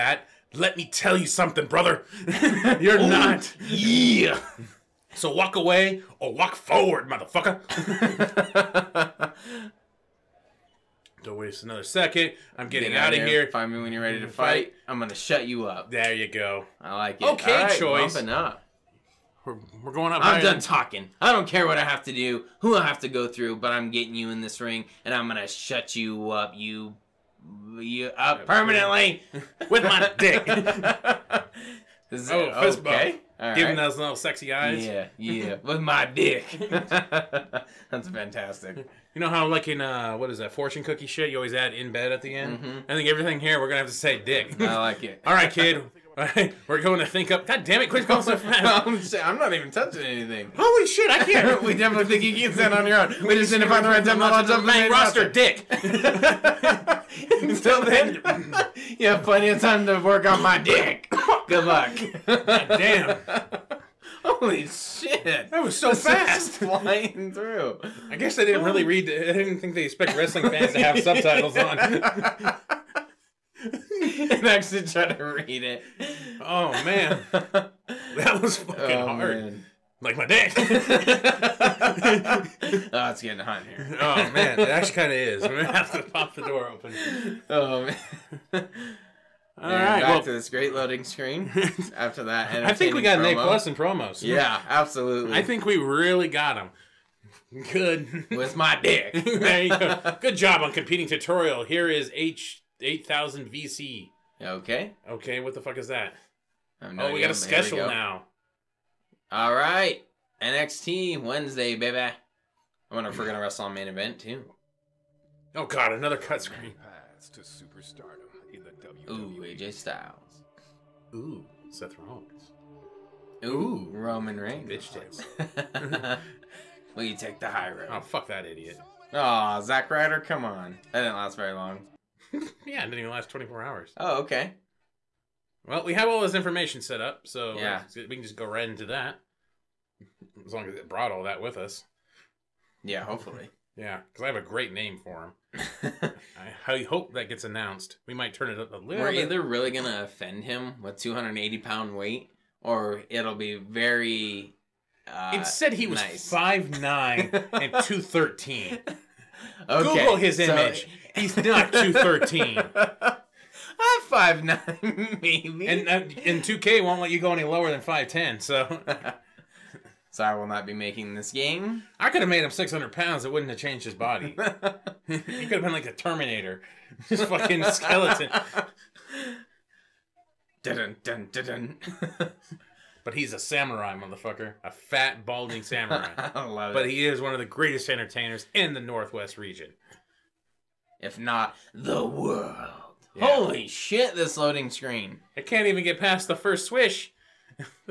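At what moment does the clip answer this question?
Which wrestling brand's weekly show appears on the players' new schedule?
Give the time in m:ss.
1:50.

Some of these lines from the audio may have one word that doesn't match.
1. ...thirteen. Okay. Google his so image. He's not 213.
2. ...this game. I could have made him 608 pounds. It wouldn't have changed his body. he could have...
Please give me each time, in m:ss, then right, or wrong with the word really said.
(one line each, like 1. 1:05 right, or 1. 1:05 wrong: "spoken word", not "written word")
1. 2:38 right
2. 2:51 wrong: "600", not "608".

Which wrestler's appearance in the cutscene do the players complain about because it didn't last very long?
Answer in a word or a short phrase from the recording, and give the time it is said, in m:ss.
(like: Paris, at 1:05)
Zack Ryder, at 2:09.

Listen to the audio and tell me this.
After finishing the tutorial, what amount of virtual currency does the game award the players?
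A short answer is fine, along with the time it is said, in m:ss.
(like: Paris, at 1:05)
8000 VC, at 1:42.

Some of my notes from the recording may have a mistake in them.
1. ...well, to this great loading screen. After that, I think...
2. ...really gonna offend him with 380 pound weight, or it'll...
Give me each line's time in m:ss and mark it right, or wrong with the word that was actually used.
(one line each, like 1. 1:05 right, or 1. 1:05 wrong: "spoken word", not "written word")
1. 1:30 right
2. 2:29 wrong: "280", not "380".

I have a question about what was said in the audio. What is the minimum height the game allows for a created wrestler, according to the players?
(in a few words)
5'10.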